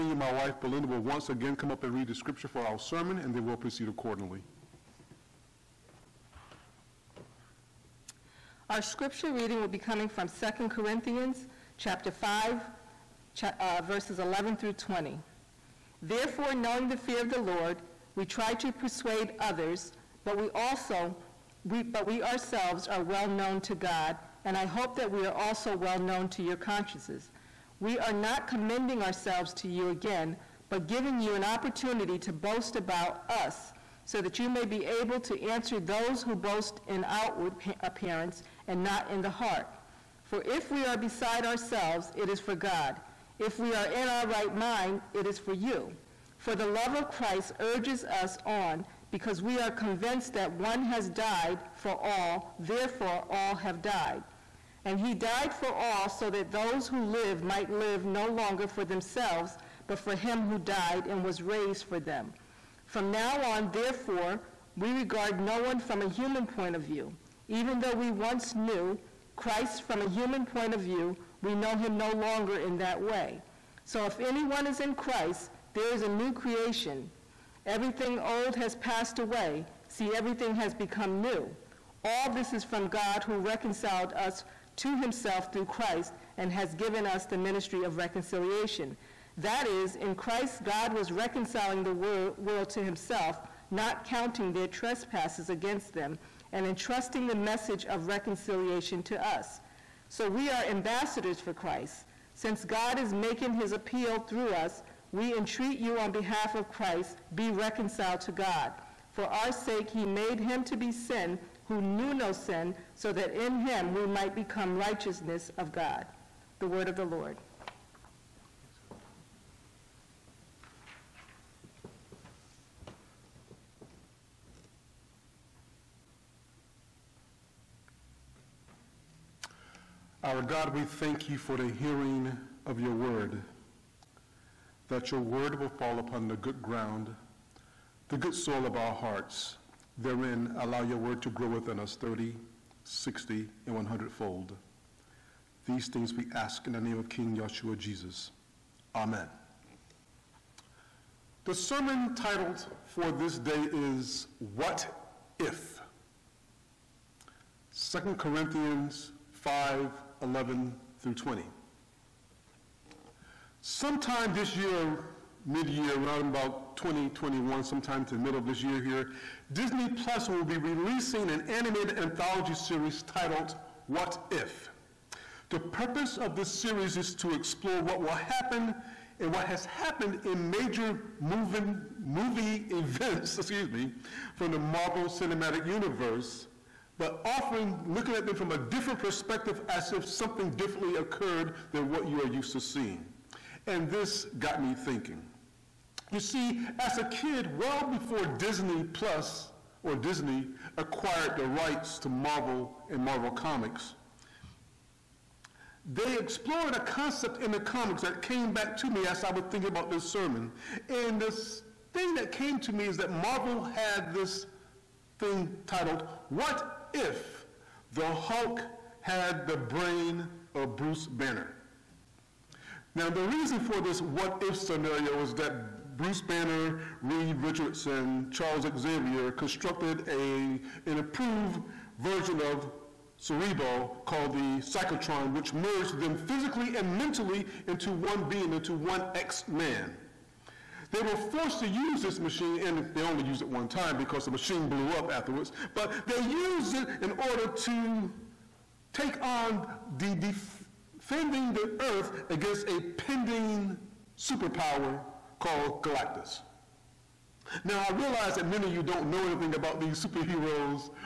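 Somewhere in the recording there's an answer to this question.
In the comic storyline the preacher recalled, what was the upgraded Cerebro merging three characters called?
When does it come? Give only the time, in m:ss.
3:54.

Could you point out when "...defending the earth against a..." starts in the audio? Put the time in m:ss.
4:10.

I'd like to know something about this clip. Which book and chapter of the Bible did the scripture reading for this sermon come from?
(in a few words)
2 Corinthians 5.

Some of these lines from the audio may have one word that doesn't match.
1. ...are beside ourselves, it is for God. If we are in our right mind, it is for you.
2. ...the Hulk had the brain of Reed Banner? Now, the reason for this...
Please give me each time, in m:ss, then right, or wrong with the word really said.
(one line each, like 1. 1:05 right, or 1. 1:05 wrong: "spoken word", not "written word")
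1. 0:40 right
2. 3:37 wrong: "Bruce", not "Reed".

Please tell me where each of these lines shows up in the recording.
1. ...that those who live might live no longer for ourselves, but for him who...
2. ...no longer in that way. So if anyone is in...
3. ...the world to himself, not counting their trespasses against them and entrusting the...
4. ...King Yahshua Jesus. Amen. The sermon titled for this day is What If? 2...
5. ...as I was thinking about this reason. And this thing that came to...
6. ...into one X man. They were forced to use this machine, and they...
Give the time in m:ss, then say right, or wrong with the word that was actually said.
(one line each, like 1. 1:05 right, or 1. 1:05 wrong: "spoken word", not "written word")
1. 0:56 wrong: "themselves", not "ourselves"
2. 1:11 right
3. 1:31 right
4. 2:27 right
5. 3:29 wrong: "sermon", not "reason"
6. 3:58 right.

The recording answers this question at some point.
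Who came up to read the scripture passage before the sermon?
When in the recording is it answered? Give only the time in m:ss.
0:00.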